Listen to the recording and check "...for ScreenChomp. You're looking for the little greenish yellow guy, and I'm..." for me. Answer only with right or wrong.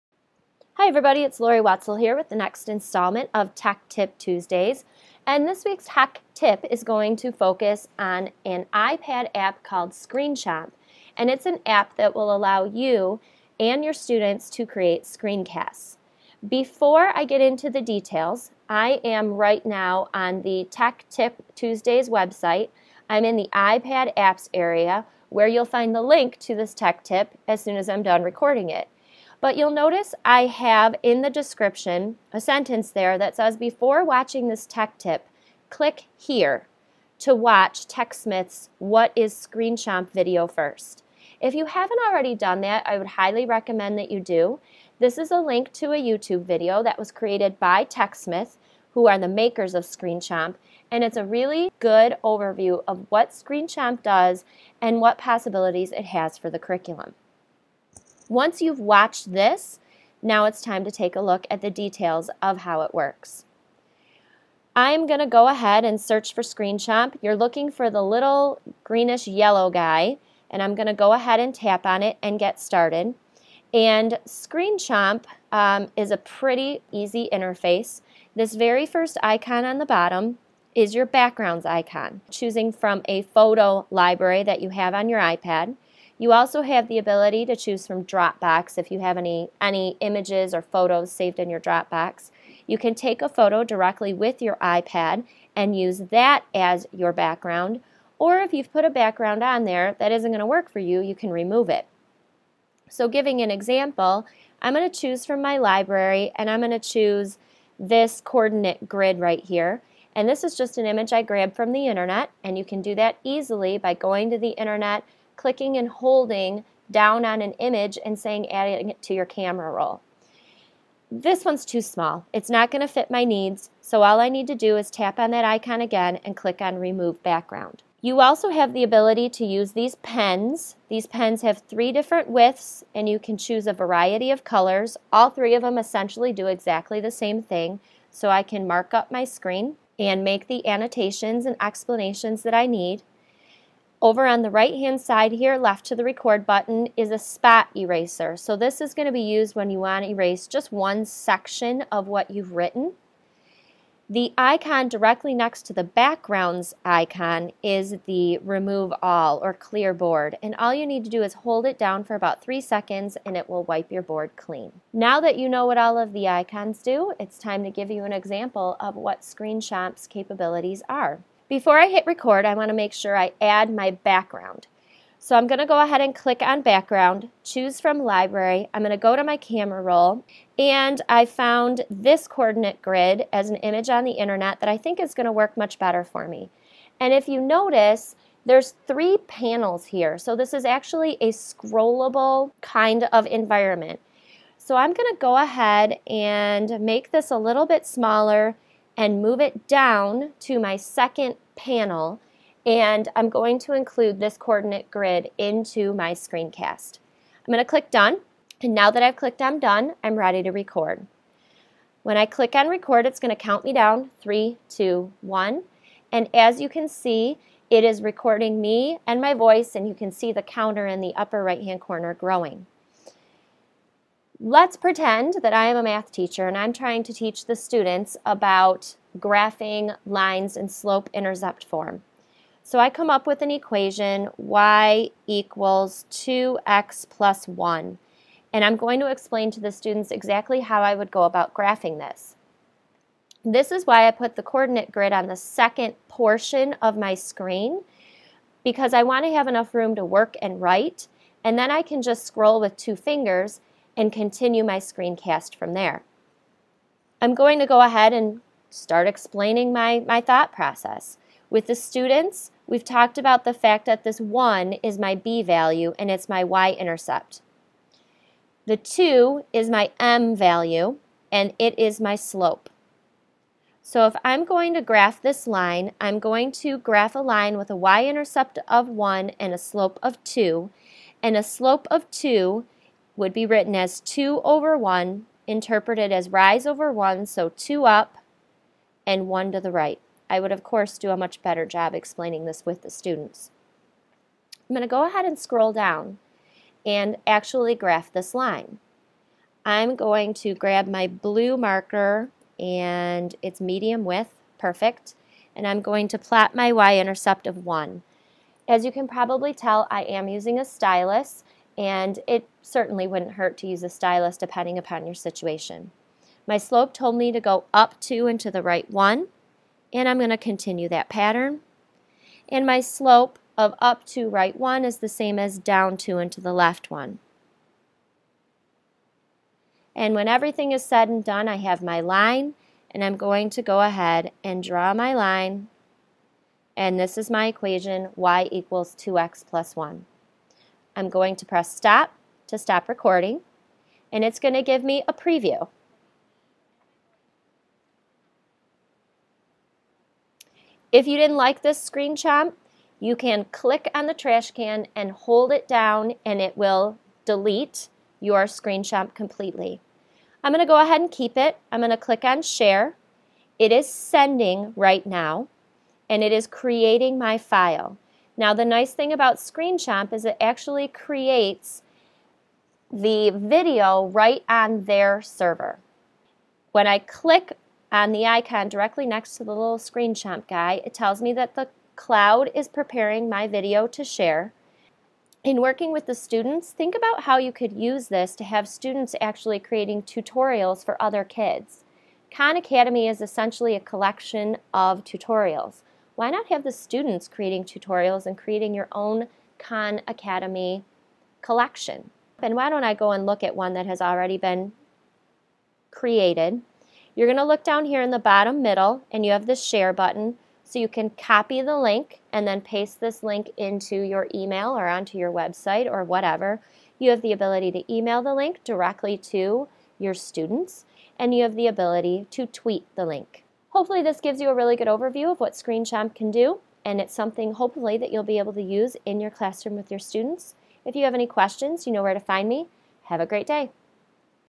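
right.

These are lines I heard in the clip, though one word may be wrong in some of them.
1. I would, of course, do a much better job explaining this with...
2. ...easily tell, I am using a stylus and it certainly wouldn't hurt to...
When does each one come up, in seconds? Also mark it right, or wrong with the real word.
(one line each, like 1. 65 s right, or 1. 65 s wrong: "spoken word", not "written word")
1. 290 s right
2. 309 s wrong: "probably", not "easily".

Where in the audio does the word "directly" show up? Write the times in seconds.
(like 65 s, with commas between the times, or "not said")
93 s, 154 s, 378 s, 418 s.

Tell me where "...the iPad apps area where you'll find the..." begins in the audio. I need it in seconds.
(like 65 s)
23 s.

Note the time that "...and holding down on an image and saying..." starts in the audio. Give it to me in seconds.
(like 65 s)
115 s.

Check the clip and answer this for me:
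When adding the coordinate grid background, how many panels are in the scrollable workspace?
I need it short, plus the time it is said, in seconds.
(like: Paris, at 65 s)
3, at 188 s.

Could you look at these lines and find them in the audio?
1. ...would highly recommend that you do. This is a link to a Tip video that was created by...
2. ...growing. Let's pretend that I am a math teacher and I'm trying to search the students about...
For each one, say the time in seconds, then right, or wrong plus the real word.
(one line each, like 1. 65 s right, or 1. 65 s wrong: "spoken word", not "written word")
1. 42 s wrong: "YouTube", not "Tip"
2. 222 s wrong: "teach", not "search".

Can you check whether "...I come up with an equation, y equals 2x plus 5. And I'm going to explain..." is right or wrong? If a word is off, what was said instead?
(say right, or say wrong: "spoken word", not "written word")
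wrong: "1", not "5".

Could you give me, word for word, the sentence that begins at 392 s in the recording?
Khan Academy is essentially a collection of tutorials why not have the students creating tutorials and creating your own Khan Academy collection?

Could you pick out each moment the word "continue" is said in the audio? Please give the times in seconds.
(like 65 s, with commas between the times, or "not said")
254 s, 320 s.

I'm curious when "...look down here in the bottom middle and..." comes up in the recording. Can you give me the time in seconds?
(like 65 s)
407 s.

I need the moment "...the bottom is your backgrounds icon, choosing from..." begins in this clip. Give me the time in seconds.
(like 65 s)
79 s.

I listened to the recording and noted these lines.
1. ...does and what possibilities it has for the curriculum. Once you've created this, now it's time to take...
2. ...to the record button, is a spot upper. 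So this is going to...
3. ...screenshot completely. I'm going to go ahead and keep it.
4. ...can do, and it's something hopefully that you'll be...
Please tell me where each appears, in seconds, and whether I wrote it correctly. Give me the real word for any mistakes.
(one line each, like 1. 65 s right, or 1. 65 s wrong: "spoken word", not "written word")
1. 54 s wrong: "watched", not "created"
2. 145 s wrong: "eraser", not "upper"
3. 358 s right
4. 426 s right.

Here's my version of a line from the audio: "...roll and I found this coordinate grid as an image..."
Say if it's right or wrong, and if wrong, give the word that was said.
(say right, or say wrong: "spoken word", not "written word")
right.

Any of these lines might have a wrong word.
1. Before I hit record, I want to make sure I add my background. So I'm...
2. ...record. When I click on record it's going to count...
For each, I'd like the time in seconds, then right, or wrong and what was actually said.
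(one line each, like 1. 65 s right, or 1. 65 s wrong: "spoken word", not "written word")
1. 171 s right
2. 210 s right.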